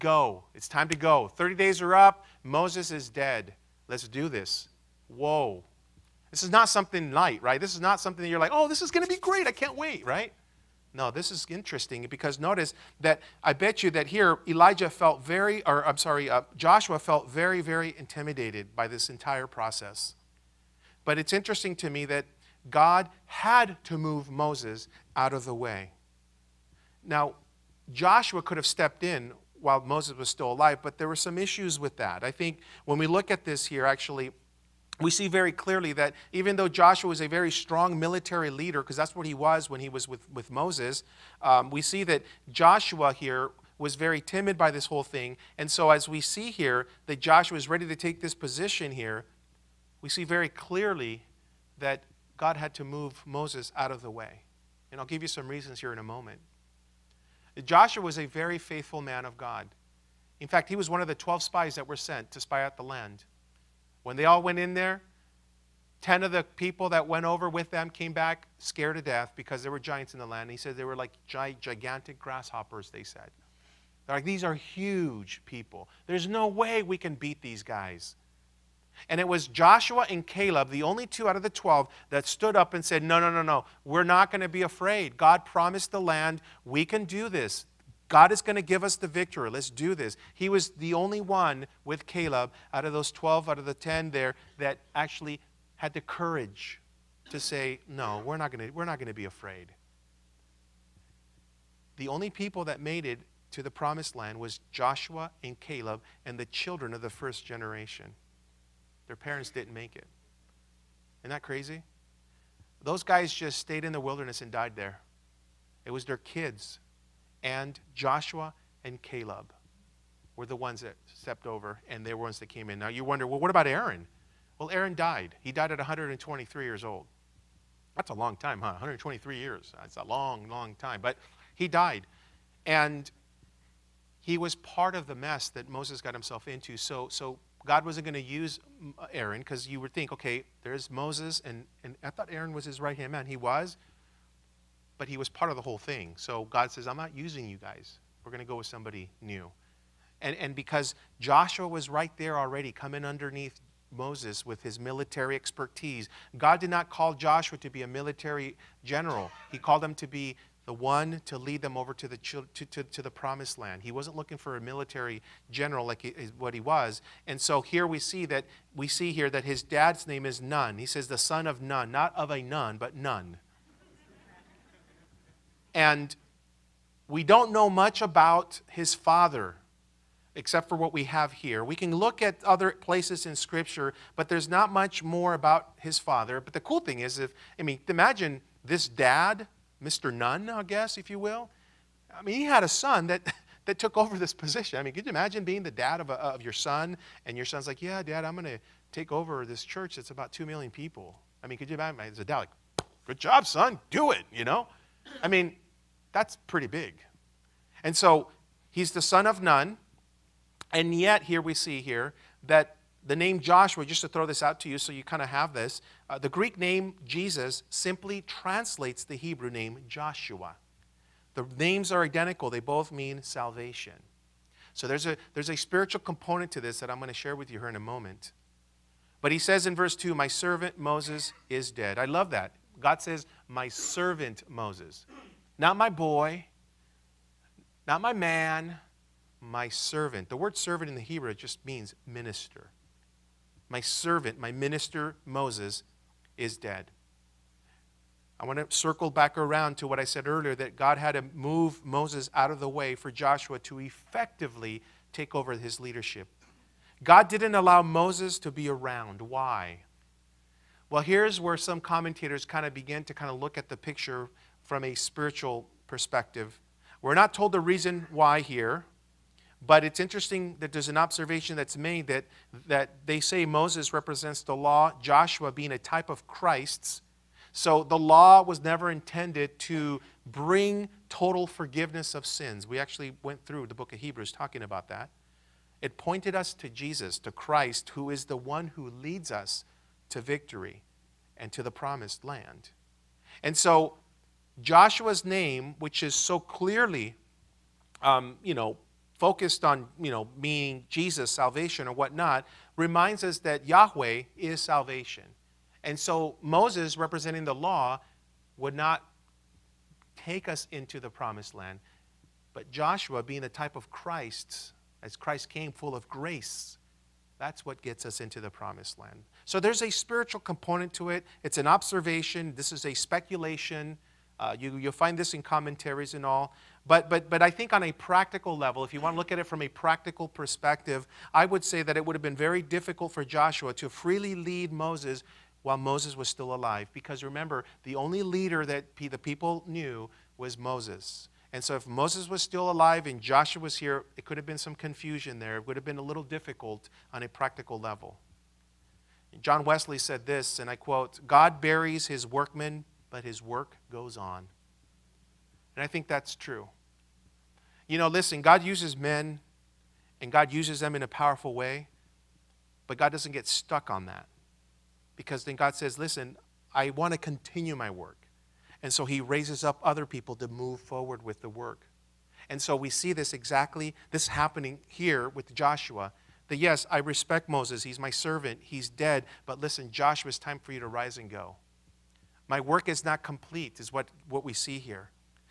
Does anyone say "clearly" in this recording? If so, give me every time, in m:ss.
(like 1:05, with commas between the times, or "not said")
0:35, 0:50, 4:56.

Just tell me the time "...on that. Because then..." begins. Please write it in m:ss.
6:03.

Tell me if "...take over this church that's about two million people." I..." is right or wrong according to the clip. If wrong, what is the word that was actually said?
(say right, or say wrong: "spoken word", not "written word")
right.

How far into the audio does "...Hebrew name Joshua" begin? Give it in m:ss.
3:39.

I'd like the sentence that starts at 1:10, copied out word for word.
And he said they were like gigantic grasshoppers, they said.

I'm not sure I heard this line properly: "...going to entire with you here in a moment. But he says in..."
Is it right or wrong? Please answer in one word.
wrong.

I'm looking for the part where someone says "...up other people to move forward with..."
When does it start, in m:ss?
6:09.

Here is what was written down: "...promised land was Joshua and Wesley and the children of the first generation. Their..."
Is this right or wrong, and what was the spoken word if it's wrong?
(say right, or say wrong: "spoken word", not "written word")
wrong: "Caleb", not "Wesley".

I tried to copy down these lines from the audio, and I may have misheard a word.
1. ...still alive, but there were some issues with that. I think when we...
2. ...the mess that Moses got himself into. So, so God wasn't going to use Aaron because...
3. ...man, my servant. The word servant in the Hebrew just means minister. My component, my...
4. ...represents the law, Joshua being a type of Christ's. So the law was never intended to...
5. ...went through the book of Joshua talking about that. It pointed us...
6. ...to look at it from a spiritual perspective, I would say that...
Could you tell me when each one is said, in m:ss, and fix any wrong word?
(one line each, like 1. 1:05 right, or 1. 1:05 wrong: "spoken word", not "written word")
1. 0:30 right
2. 2:15 right
3. 3:58 wrong: "servant", not "component"
4. 4:33 right
5. 4:43 wrong: "Hebrews", not "Joshua"
6. 5:29 wrong: "practical", not "spiritual".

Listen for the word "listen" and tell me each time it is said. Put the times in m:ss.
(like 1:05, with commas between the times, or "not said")
5:58, 6:05, 6:19.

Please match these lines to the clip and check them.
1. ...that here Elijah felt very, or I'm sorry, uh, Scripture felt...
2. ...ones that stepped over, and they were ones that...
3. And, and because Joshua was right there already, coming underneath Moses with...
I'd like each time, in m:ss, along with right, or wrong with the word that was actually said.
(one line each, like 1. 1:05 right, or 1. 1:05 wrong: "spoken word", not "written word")
1. 0:13 wrong: "Joshua", not "Scripture"
2. 2:00 right
3. 2:30 right.